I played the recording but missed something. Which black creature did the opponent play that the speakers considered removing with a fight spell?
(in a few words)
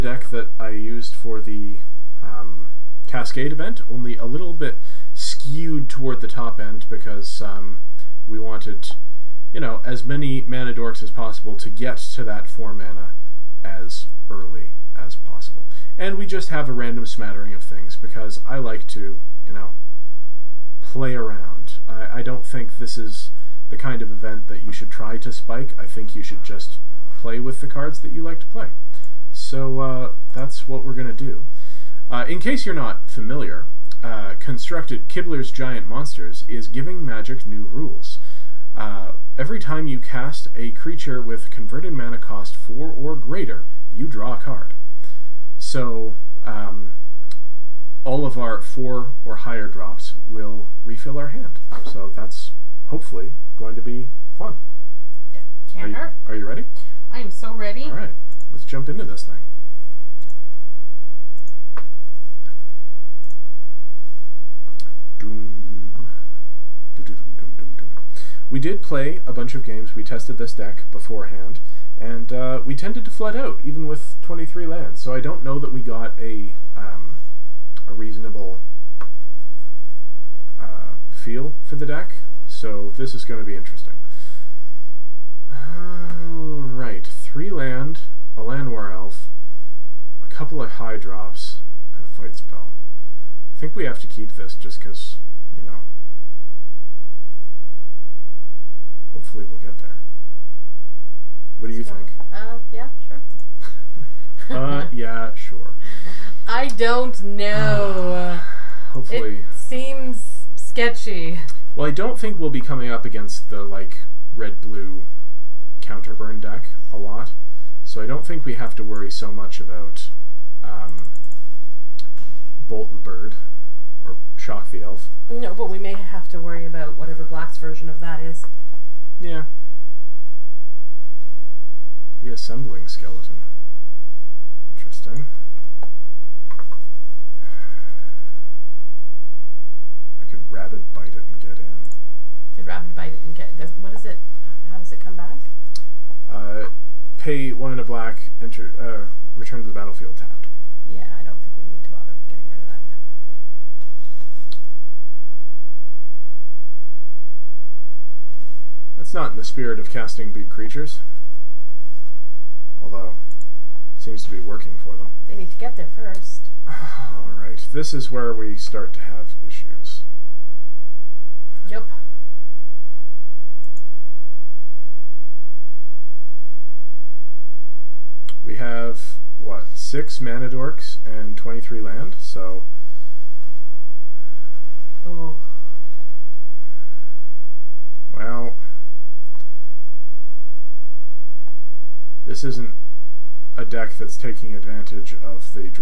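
Reassembling Skeleton.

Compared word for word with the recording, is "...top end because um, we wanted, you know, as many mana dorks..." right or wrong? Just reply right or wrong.
right.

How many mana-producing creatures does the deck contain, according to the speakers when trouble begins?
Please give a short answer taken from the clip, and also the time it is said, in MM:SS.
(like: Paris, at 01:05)
6, at 02:59.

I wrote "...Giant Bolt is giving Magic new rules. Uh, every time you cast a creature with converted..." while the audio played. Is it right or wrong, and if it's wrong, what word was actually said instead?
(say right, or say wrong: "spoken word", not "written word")
wrong: "Monsters", not "Bolt".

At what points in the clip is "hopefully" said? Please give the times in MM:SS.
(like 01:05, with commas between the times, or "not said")
00:52, 01:39, 01:48.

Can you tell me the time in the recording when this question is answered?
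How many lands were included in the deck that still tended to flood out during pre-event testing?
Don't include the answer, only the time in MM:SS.
01:14.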